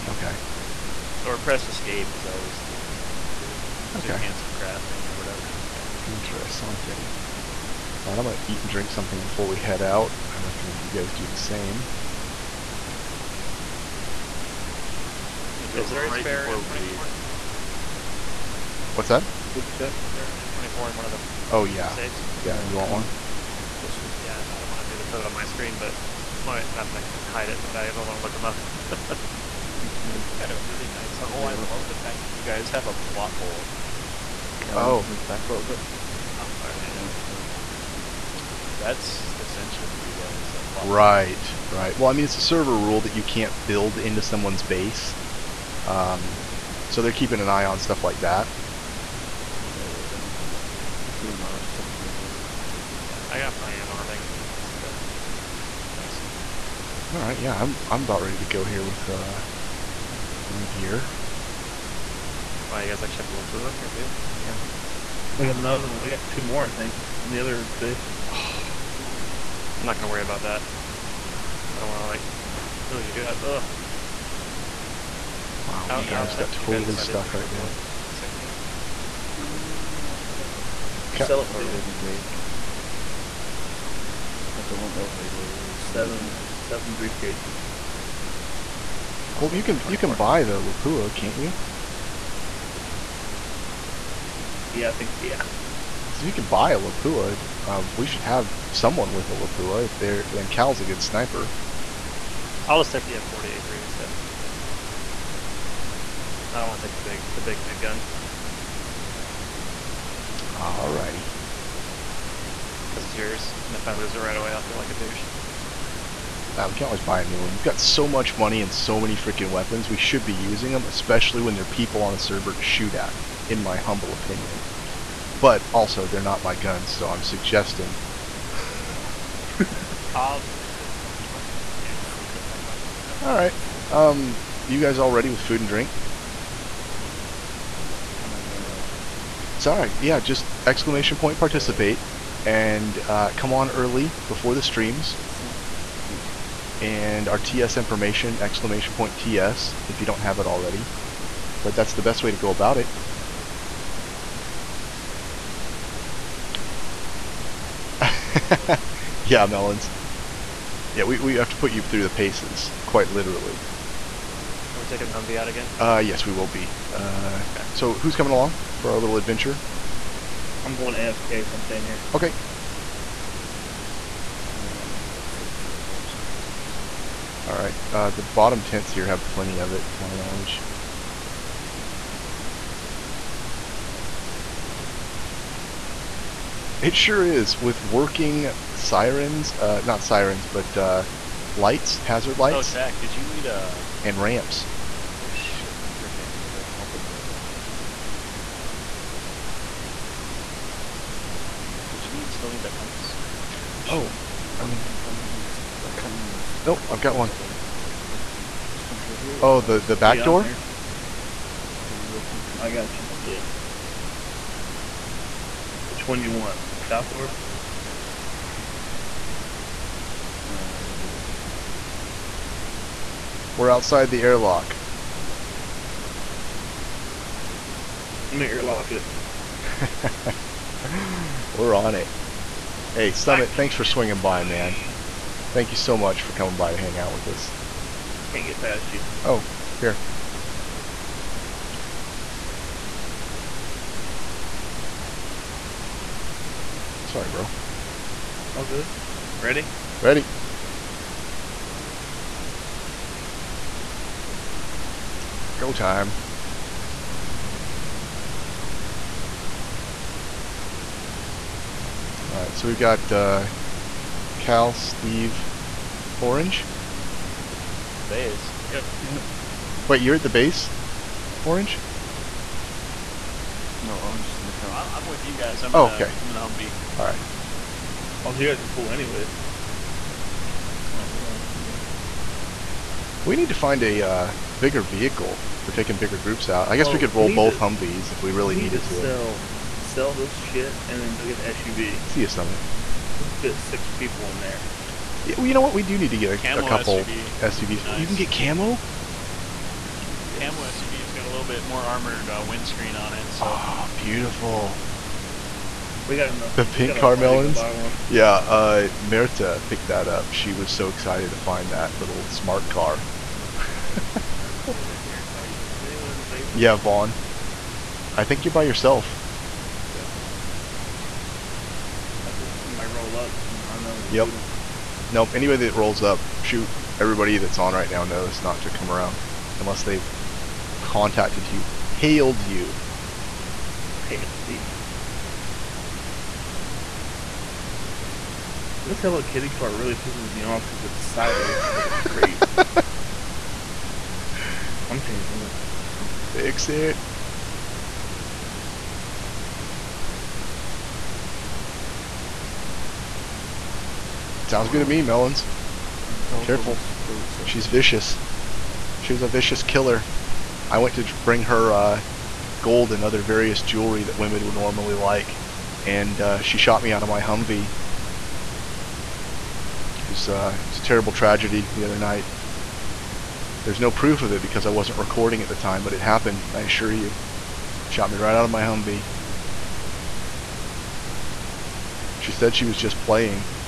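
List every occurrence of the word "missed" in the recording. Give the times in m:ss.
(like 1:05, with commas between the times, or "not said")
not said.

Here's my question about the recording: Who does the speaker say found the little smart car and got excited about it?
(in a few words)
Merta.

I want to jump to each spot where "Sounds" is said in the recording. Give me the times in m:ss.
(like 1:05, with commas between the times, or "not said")
5:54.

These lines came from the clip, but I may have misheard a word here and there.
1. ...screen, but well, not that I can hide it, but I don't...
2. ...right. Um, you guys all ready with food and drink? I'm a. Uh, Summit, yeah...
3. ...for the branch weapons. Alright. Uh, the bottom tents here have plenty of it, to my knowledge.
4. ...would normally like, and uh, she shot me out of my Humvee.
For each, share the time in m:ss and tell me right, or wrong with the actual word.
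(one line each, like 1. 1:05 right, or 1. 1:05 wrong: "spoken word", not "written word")
1. 0:25 right
2. 2:13 wrong: "Sorry", not "Summit"
3. 2:55 wrong: "artisans", not "weapons"
4. 6:04 right.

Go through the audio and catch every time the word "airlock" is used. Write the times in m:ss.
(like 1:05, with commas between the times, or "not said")
3:44, 3:48.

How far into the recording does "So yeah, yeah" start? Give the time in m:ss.
0:36.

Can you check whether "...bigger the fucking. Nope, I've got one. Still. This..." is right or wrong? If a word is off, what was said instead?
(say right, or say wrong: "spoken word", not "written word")
wrong: "remember", not "bigger".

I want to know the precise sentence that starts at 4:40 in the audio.
Oh, yeah, I think, We need to find a uh, bigger vehicle for taking bigger groups out.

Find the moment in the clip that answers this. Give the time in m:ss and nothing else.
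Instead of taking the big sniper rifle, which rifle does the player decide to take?
1:43.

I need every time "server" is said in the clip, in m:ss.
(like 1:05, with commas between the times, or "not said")
0:42, 2:02.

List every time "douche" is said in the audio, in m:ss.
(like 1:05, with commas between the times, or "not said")
1:54.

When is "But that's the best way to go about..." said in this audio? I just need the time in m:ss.
2:31.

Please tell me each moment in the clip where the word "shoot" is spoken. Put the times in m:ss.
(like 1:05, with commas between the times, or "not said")
2:02, 5:26.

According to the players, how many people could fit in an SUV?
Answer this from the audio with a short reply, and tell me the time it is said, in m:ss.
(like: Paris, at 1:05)
6, at 4:53.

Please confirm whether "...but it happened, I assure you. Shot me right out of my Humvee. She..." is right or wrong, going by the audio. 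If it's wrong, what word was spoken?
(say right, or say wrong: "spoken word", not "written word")
right.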